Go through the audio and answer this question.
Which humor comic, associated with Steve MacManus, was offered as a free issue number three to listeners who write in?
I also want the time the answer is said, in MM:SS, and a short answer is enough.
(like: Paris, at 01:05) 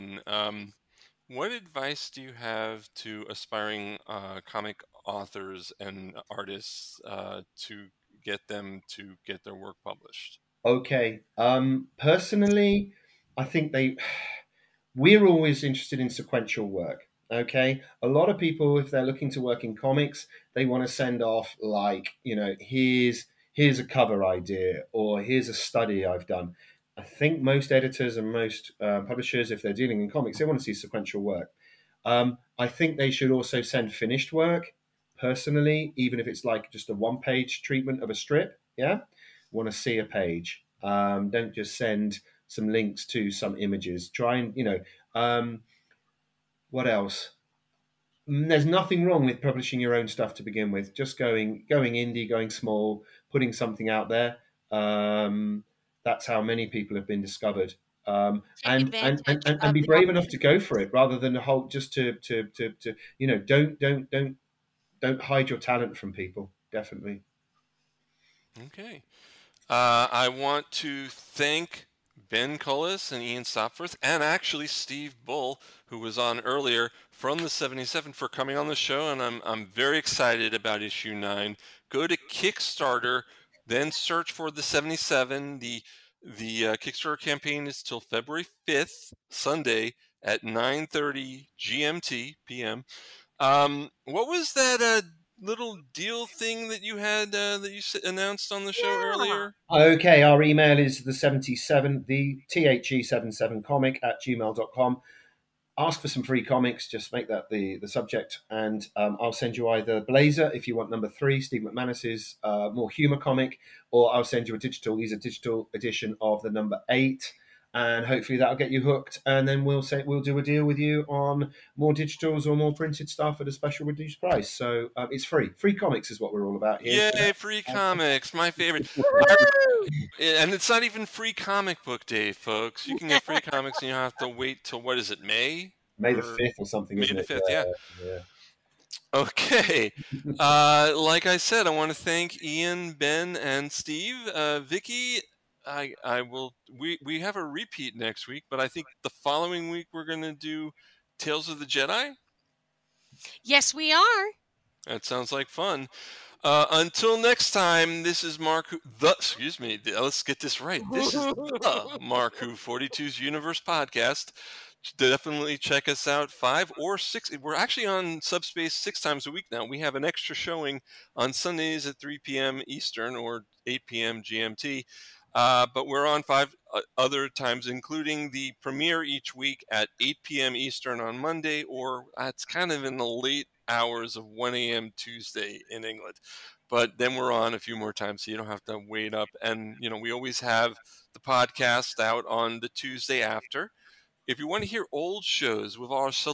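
Blazer, at 01:50.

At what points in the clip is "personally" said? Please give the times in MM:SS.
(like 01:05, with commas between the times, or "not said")
00:11, 00:35.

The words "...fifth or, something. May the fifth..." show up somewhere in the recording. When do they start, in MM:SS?
02:16.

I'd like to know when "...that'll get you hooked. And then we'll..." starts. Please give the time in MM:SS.
01:58.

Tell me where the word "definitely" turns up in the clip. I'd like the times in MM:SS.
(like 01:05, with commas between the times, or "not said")
01:06, 02:44.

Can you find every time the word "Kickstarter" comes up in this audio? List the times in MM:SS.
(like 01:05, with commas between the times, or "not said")
01:22, 01:26.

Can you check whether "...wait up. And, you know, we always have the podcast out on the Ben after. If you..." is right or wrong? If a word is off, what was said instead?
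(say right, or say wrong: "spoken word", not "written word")
wrong: "Tuesday", not "Ben".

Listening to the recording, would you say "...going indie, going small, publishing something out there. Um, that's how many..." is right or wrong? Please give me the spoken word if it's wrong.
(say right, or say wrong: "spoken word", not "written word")
wrong: "putting", not "publishing".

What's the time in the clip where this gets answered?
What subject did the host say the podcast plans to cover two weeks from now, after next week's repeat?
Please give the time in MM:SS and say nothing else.
02:31.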